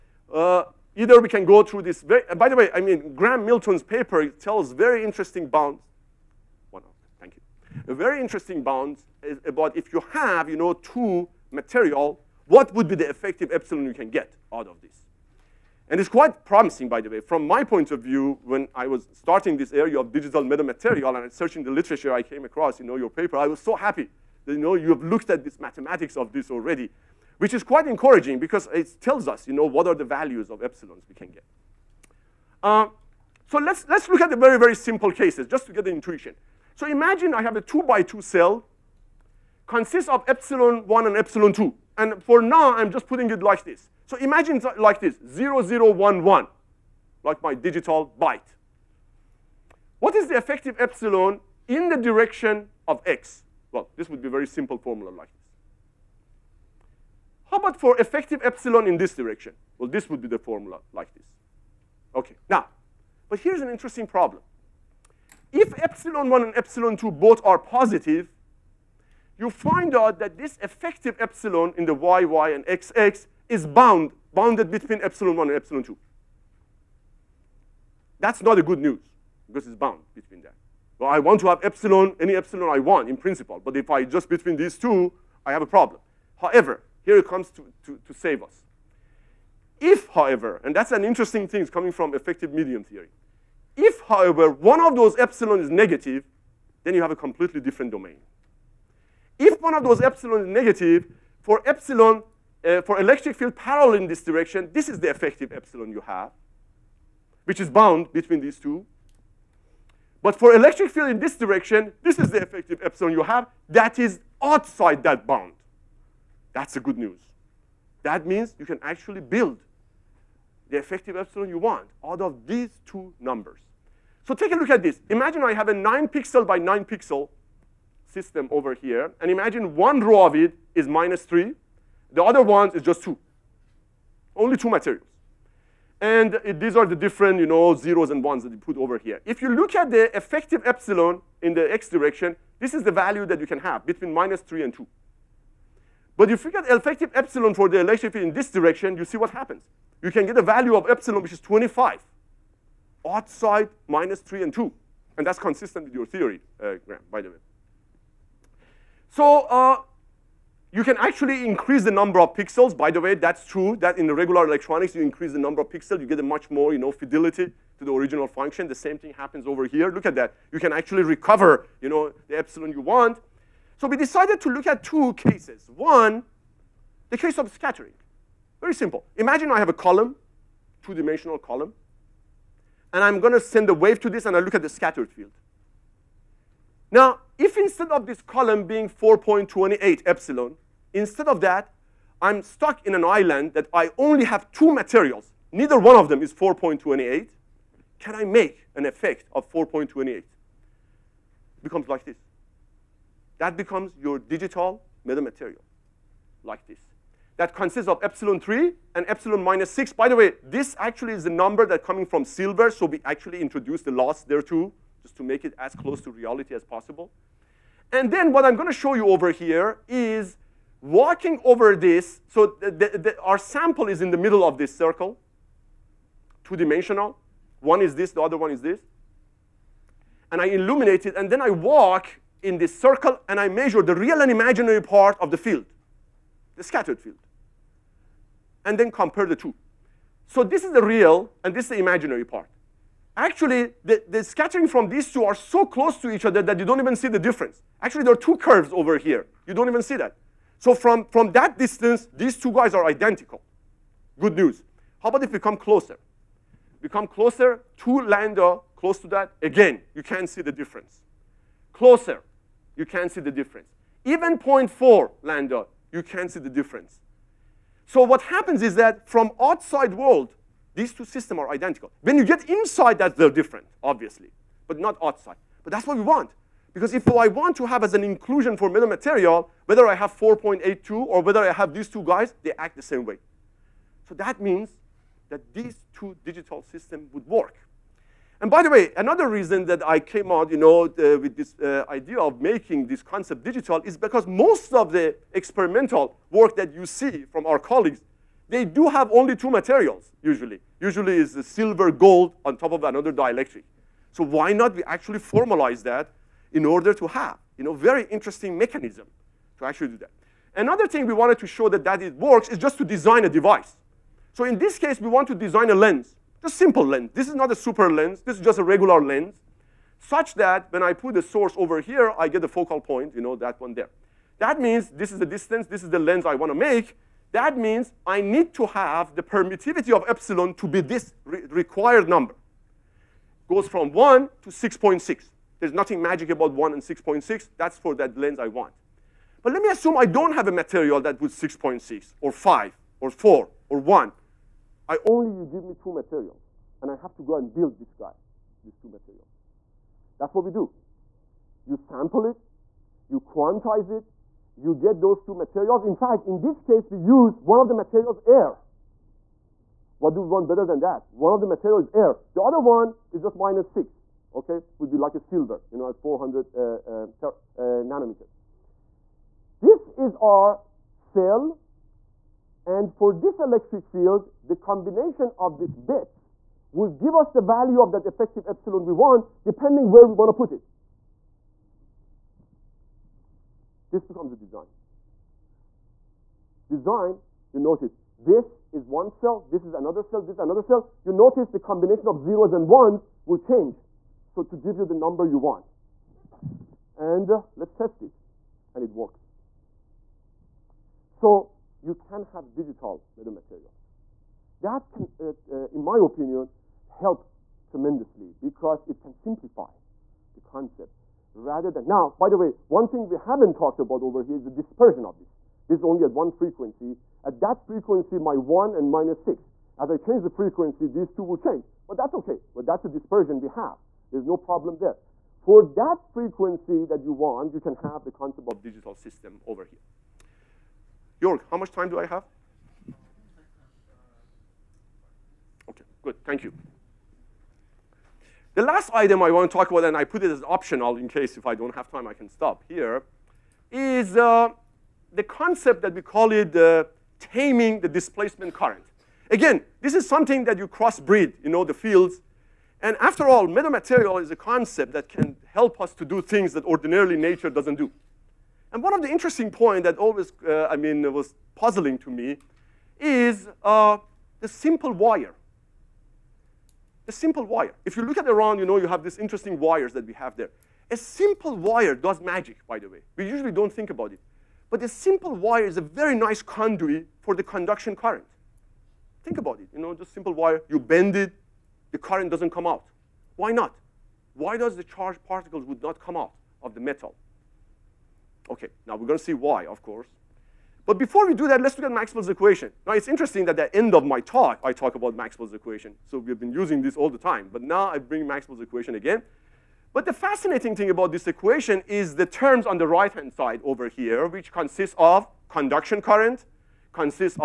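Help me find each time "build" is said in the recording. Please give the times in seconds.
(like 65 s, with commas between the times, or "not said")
119 s, 347 s.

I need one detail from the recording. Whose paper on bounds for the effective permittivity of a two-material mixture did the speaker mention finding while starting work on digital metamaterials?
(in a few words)
Graham Milton.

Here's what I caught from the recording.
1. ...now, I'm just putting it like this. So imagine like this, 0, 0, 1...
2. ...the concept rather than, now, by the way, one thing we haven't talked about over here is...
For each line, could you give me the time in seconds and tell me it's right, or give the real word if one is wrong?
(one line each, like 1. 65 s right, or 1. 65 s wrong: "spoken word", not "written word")
1. 42 s right
2. 410 s right.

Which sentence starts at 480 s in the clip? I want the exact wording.
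You bend it, the current doesn't come out.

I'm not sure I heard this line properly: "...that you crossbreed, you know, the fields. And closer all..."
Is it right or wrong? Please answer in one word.
wrong.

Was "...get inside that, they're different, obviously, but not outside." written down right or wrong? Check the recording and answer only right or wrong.
right.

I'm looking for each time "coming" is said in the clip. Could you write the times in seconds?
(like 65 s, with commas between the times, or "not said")
91 s, 211 s.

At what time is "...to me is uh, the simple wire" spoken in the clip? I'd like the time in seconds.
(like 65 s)
461 s.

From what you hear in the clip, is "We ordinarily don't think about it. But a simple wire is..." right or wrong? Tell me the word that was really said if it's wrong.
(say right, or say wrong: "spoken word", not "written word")
wrong: "usually", not "ordinarily".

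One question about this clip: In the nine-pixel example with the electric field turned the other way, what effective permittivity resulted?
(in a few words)
25.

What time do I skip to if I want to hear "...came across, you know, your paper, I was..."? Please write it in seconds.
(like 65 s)
22 s.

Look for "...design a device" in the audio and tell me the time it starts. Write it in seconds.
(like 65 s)
312 s.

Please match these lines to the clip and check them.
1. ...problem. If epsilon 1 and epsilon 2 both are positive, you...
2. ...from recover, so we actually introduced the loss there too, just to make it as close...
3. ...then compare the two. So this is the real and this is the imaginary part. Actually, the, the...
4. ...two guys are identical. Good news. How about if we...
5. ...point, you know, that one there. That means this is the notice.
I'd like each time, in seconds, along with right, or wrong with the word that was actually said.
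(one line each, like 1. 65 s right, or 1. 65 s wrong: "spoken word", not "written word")
1. 64 s right
2. 212 s wrong: "silver", not "recover"
3. 238 s right
4. 252 s right
5. 322 s wrong: "distance", not "notice".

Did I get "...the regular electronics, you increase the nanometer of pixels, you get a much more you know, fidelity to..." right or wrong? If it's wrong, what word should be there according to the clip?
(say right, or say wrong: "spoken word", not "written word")
wrong: "number", not "nanometer".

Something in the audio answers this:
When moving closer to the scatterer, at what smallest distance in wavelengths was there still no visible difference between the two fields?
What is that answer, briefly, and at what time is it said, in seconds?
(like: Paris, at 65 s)
0.4 lambda, at 264 s.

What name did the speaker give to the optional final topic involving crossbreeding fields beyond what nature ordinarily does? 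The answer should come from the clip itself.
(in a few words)
taming the displacement current.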